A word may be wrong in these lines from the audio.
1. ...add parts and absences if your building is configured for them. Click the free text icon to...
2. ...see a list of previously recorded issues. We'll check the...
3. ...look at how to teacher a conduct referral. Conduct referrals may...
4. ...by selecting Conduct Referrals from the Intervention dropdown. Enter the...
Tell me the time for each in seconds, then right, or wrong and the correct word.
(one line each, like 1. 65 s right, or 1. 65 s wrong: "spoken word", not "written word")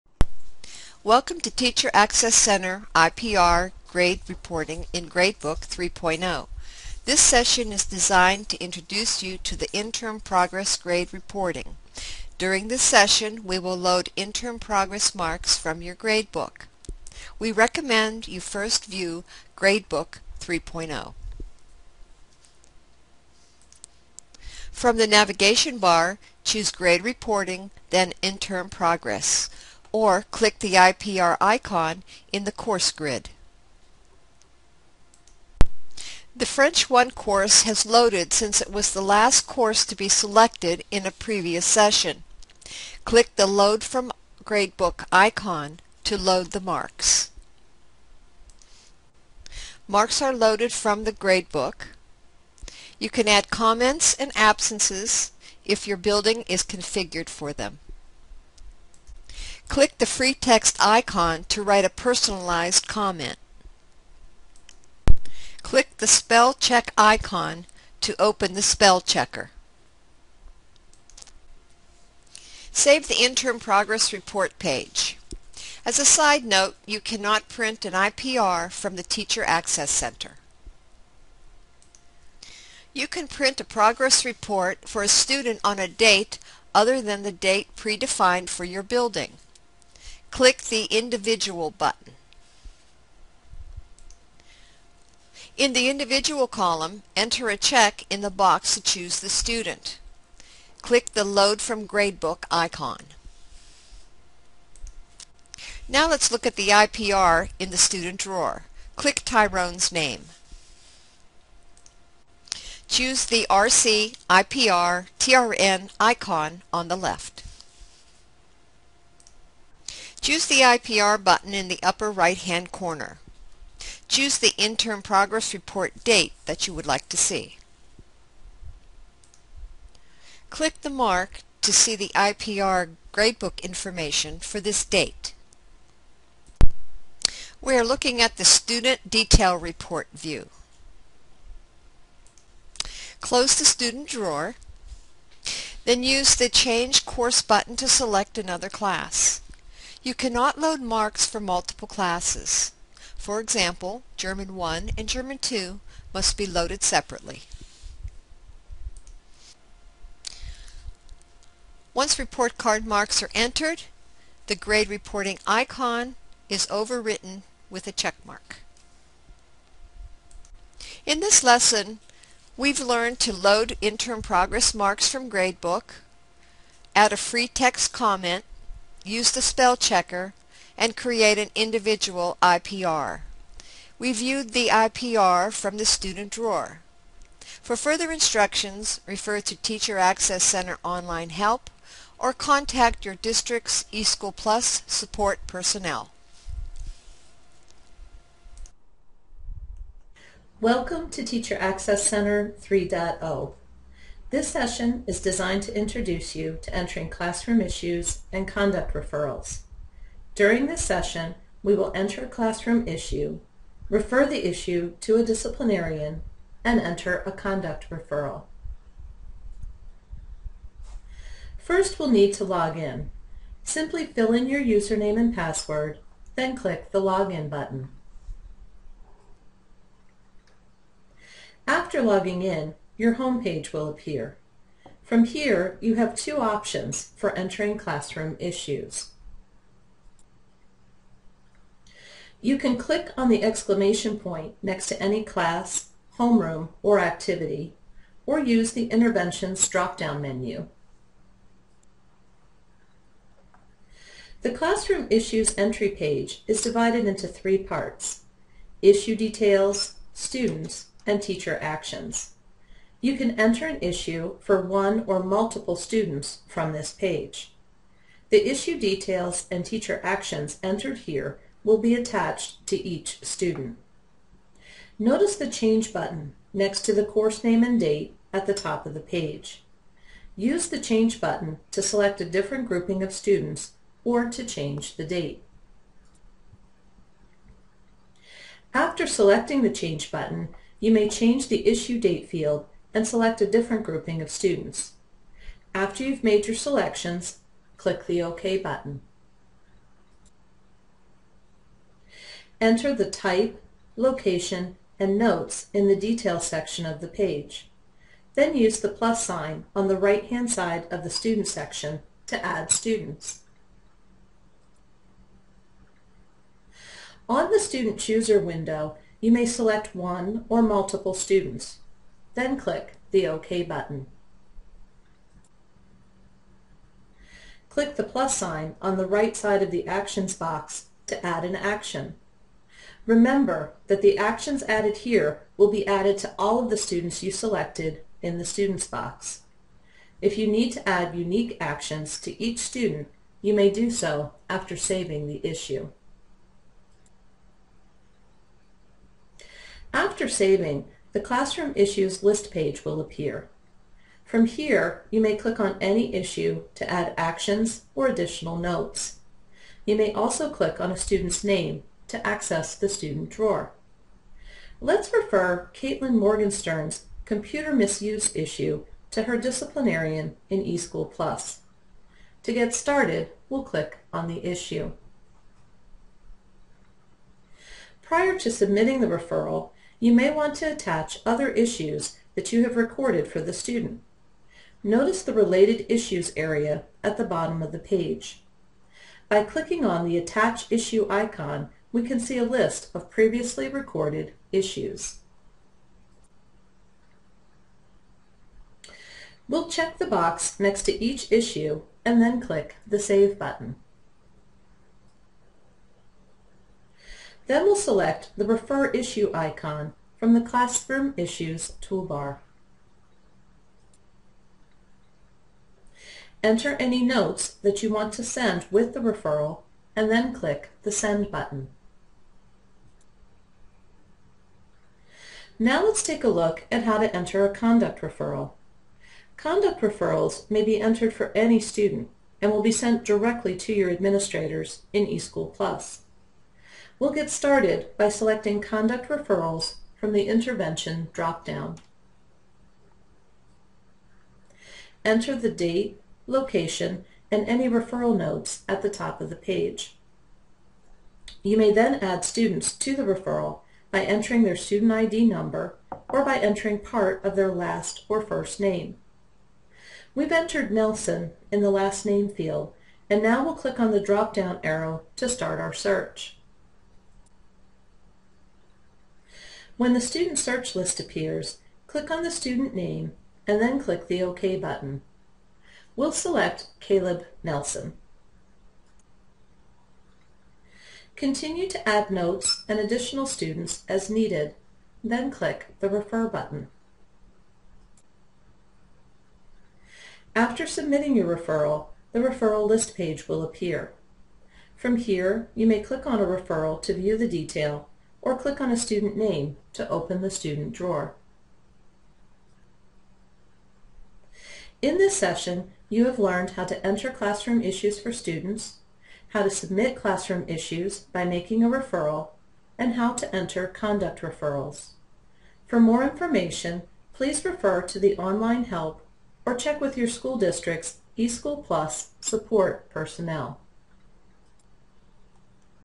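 1. 53 s wrong: "comments", not "parts"
2. 392 s right
3. 426 s wrong: "enter", not "teacher"
4. 437 s right.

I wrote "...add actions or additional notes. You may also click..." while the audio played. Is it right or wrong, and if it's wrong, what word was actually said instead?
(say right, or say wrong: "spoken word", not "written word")
right.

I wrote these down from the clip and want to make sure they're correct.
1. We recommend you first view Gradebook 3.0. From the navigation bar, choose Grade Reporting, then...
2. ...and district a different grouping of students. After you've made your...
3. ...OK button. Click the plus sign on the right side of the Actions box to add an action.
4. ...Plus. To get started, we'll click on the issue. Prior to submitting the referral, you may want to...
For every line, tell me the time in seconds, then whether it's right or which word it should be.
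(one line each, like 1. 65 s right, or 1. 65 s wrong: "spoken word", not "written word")
1. 17 s right
2. 292 s wrong: "select", not "district"
3. 323 s right
4. 371 s right.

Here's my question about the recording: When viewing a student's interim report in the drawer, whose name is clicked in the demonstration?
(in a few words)
Tyrone.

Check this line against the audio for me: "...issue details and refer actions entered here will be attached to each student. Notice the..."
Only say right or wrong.
wrong.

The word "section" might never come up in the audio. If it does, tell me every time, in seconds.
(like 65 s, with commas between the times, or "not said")
306 s, 311 s.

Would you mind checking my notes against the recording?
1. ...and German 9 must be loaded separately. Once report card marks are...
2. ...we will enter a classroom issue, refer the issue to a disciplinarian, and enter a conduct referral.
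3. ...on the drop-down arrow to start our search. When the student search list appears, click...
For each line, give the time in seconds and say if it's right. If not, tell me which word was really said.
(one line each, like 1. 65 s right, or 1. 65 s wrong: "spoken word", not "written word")
1. 154 s wrong: "2", not "9"
2. 211 s right
3. 463 s right.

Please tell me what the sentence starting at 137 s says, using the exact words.
We are looking at the Student Detail Report view.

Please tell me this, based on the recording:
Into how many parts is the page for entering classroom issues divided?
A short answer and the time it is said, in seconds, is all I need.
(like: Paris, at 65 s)
3, at 257 s.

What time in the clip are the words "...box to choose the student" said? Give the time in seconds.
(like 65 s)
98 s.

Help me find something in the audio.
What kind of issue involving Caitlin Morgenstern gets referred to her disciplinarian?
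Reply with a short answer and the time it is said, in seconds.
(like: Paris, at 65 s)
computer misuse, at 367 s.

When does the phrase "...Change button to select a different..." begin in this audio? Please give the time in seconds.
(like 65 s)
280 s.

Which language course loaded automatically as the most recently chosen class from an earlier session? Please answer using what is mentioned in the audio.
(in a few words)
French 1.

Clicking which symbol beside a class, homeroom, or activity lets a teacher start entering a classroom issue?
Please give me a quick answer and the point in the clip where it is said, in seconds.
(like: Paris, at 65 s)
exclamation point, at 243 s.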